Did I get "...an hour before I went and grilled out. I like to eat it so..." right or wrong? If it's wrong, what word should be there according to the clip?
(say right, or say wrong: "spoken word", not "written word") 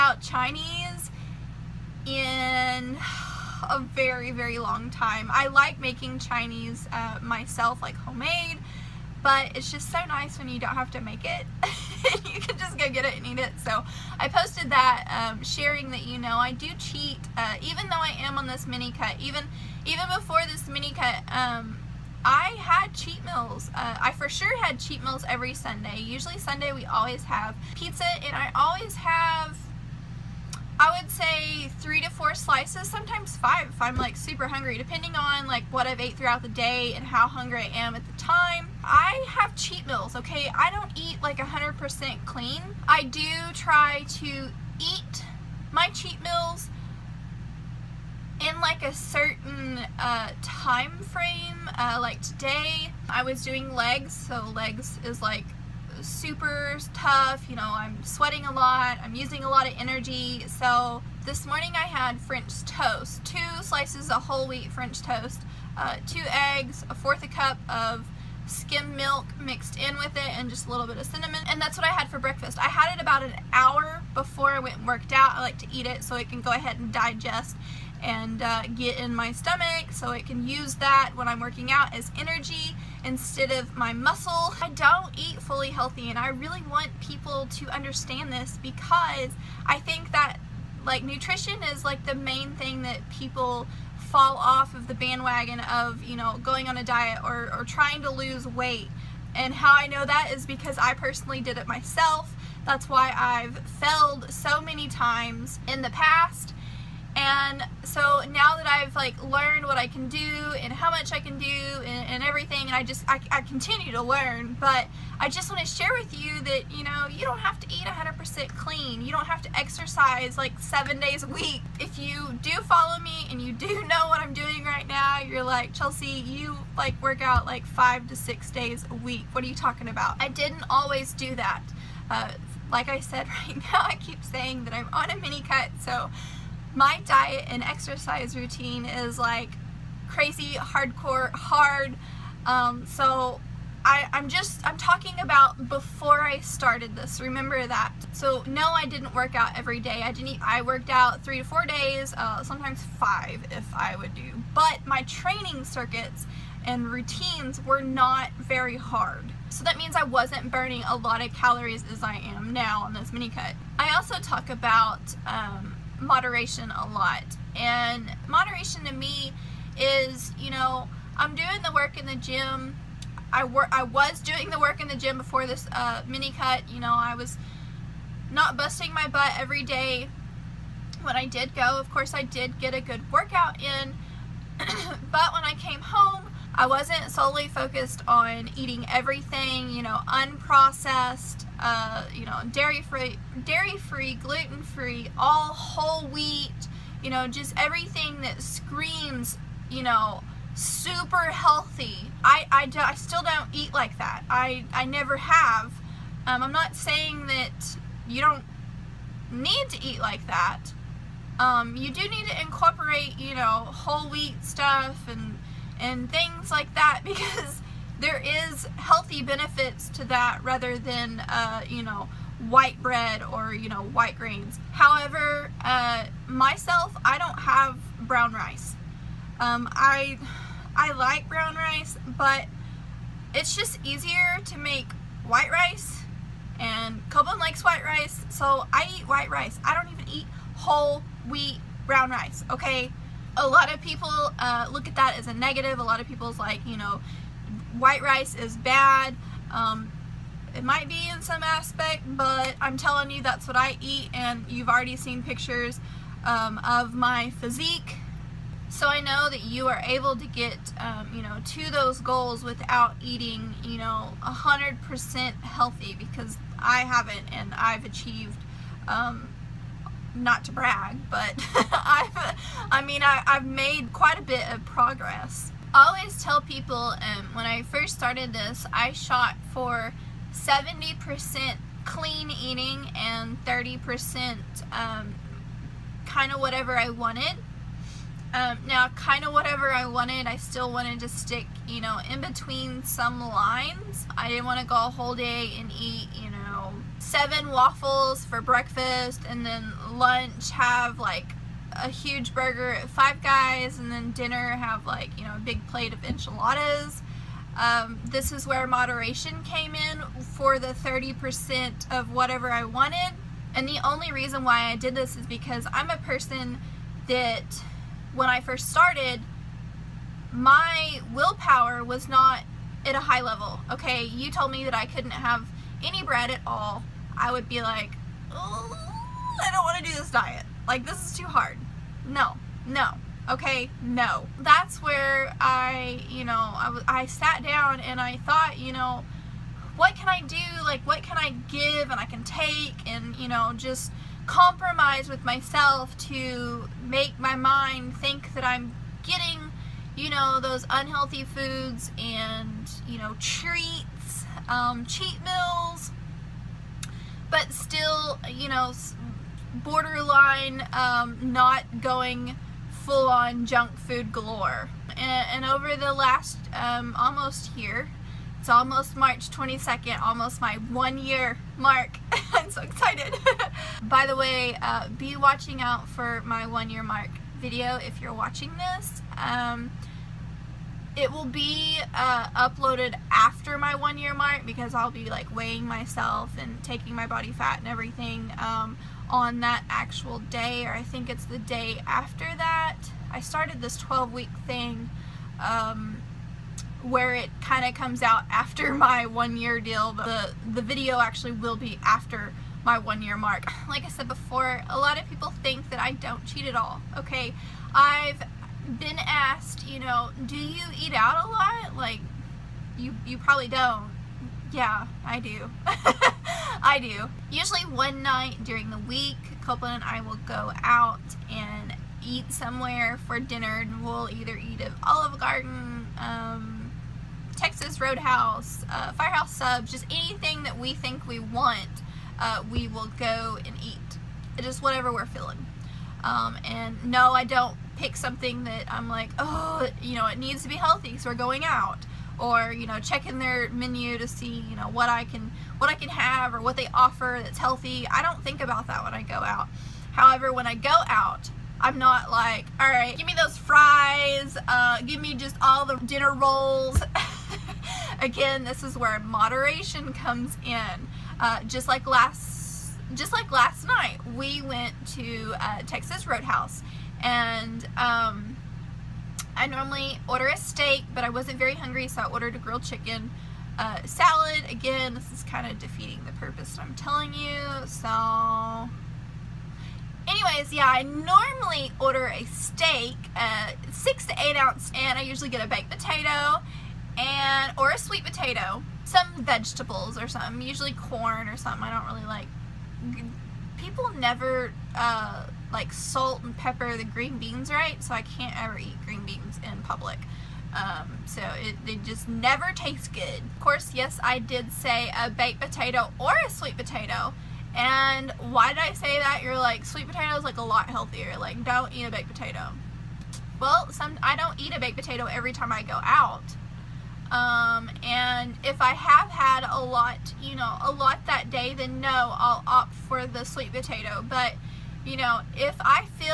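wrong: "worked", not "grilled".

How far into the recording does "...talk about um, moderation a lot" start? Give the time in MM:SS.
02:44.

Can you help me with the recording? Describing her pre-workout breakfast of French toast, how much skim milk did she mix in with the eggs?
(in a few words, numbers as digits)
a fourth a cup.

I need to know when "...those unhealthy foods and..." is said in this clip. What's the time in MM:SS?
05:50.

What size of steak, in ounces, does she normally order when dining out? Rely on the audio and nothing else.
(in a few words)
6 to 8 ounces.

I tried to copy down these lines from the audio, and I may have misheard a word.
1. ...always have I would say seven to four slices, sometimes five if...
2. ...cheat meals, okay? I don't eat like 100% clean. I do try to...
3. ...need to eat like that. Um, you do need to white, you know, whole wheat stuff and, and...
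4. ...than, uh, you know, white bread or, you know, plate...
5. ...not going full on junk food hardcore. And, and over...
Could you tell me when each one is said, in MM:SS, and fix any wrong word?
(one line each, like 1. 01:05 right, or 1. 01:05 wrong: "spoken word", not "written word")
1. 00:28 wrong: "three", not "seven"
2. 00:39 right
3. 03:29 wrong: "incorporate", not "white"
4. 03:40 wrong: "white", not "plate"
5. 06:01 wrong: "galore", not "hardcore".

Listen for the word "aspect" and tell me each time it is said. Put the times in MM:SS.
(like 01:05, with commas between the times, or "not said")
04:11.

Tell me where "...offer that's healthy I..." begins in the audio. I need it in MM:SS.
07:26.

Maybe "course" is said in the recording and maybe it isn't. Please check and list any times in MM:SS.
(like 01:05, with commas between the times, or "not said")
03:01, 08:23.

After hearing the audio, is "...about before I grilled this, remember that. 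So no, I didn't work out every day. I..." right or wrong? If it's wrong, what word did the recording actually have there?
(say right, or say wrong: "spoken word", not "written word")
wrong: "started", not "grilled".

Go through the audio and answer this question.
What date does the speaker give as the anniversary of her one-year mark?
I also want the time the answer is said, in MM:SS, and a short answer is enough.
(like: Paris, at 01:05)
March 22nd, at 06:08.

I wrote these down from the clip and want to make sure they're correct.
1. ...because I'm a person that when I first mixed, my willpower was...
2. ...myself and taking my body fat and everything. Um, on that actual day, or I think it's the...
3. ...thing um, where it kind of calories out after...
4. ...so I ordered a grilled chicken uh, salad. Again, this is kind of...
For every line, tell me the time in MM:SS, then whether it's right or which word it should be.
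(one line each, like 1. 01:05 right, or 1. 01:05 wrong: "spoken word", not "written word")
1. 05:15 wrong: "started", not "mixed"
2. 06:25 right
3. 06:34 wrong: "comes", not "calories"
4. 07:51 right.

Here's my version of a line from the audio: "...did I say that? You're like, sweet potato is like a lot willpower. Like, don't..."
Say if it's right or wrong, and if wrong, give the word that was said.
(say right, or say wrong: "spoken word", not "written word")
wrong: "healthier", not "willpower".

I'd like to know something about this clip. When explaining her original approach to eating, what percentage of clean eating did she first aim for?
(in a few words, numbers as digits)
70%.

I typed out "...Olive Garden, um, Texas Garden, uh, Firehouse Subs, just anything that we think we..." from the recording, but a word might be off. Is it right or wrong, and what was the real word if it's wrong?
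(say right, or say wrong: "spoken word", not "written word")
wrong: "Roadhouse", not "Garden".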